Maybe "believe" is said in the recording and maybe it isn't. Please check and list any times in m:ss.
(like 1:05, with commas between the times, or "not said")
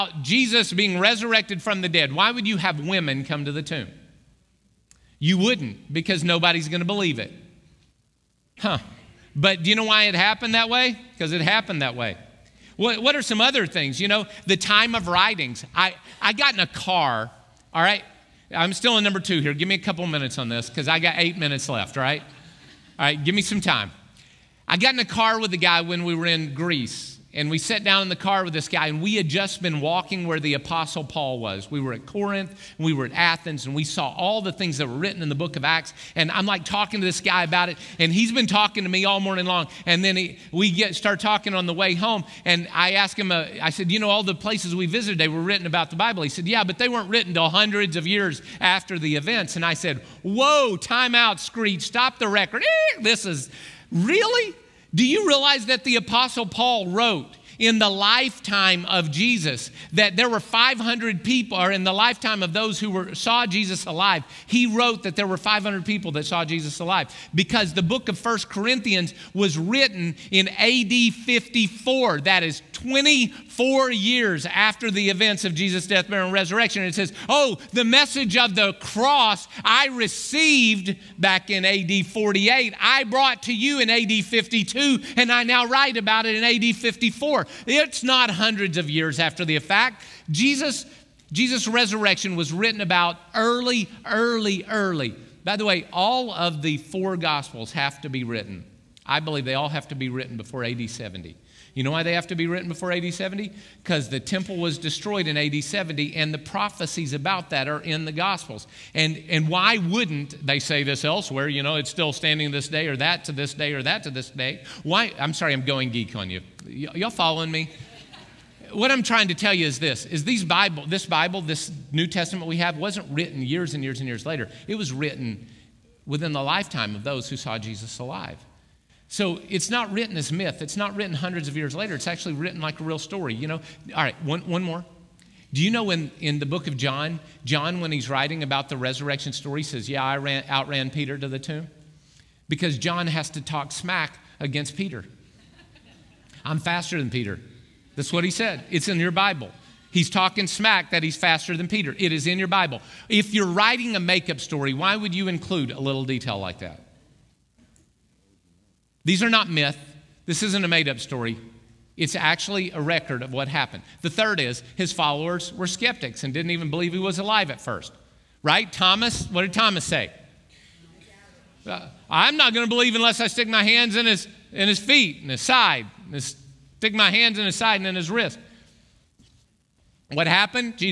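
0:06, 1:39, 2:46, 2:52.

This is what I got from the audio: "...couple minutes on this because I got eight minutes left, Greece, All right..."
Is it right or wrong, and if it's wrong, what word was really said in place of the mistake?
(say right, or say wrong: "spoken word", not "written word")
wrong: "Right", not "Greece".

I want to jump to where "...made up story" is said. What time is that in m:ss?
2:40.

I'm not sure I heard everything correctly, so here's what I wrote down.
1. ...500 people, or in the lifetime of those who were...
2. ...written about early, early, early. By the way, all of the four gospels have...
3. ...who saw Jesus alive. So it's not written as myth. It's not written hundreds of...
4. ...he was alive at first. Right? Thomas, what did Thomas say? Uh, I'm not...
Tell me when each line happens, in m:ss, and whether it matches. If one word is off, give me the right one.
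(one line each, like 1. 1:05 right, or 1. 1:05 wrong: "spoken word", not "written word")
1. 1:00 right
2. 1:32 right
3. 2:07 right
4. 2:46 right.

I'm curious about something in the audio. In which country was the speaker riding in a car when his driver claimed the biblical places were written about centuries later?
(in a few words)
Greece.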